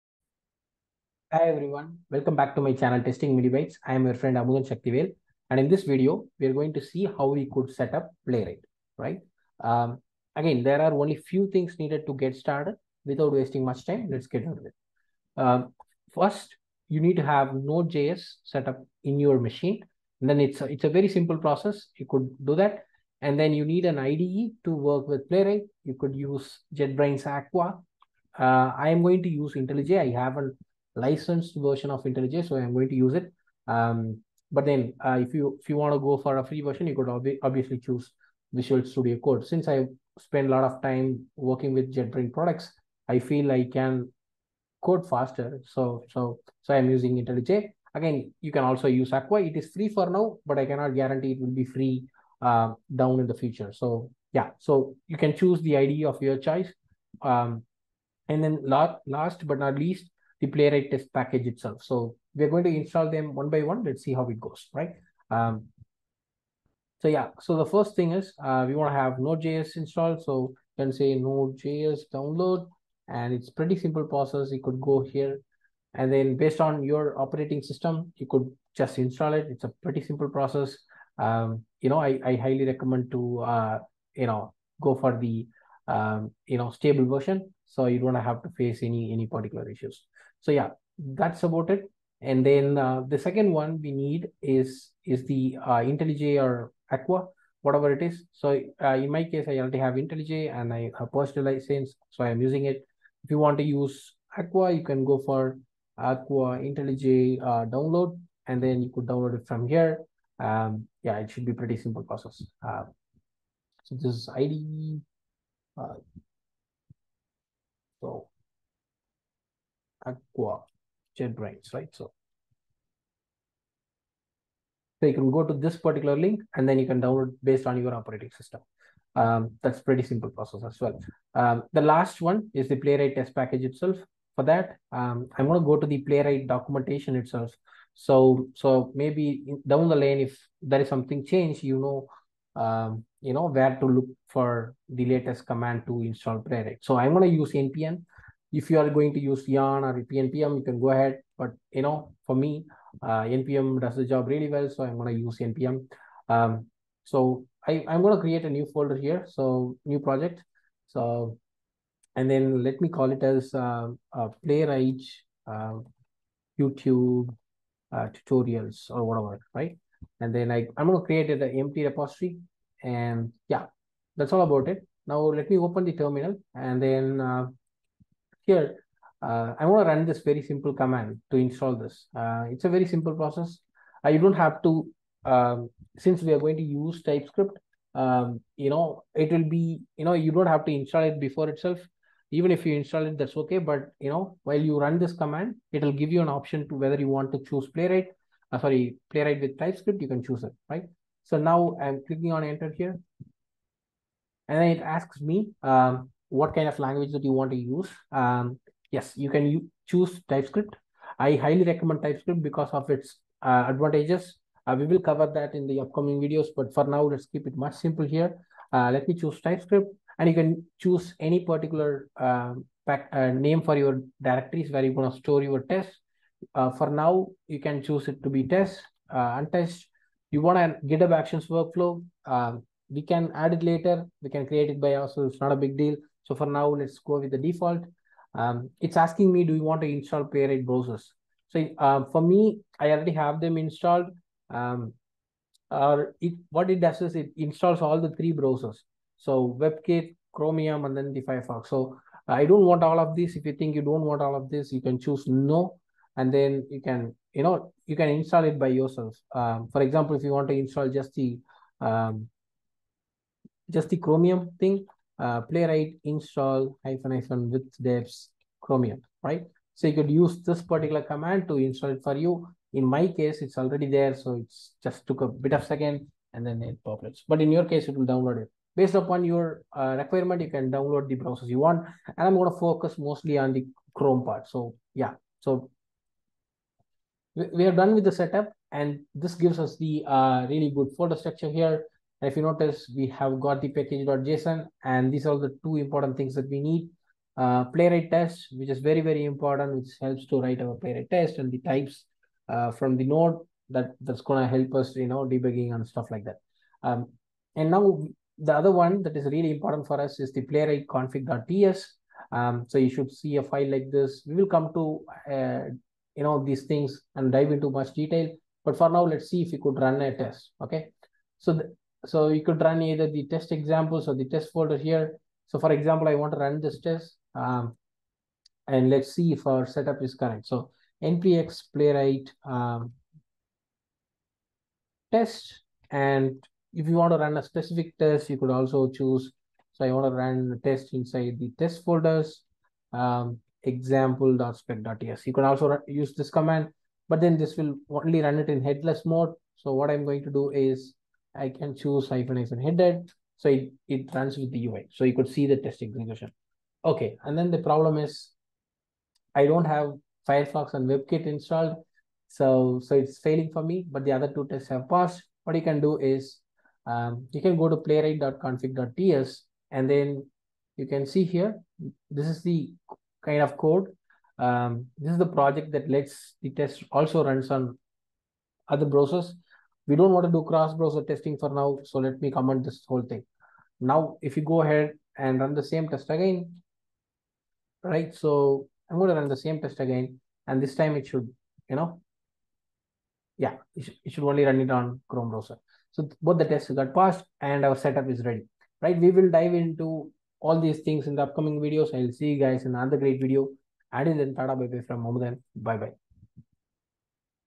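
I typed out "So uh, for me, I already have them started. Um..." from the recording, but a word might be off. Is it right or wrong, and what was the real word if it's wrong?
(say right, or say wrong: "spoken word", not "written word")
wrong: "installed", not "started".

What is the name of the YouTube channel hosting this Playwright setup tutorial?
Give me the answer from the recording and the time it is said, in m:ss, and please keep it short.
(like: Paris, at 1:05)
Testing Mini Bytes, at 0:03.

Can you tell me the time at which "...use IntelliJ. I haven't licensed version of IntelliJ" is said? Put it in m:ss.
0:29.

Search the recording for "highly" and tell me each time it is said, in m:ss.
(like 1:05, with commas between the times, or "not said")
1:22, 3:31.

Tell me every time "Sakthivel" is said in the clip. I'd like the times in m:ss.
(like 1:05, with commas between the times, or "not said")
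0:04.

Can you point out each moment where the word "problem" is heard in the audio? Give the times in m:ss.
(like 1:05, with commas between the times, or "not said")
5:57.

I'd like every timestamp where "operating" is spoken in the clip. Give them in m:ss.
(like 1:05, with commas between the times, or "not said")
1:17, 2:07.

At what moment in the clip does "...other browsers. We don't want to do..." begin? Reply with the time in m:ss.
6:18.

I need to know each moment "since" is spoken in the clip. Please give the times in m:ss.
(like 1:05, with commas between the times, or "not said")
0:39, 3:05.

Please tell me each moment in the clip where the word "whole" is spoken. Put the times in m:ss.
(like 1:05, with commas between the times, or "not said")
6:22.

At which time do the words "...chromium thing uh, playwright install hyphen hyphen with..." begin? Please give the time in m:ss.
4:23.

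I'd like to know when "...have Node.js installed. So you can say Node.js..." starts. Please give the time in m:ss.
1:08.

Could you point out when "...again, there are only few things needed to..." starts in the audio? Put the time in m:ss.
0:10.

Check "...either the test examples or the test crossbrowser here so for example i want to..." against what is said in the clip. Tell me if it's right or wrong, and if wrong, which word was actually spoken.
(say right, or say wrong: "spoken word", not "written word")
wrong: "folder", not "crossbrowser".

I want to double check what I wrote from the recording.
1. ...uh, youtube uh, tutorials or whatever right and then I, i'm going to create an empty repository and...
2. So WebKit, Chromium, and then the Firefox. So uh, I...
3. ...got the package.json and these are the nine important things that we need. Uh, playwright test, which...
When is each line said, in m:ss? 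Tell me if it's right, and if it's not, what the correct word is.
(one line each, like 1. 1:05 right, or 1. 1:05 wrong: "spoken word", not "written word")
1. 2:45 right
2. 4:09 right
3. 4:53 wrong: "two", not "nine".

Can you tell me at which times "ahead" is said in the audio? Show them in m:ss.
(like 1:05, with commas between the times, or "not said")
2:30, 6:24.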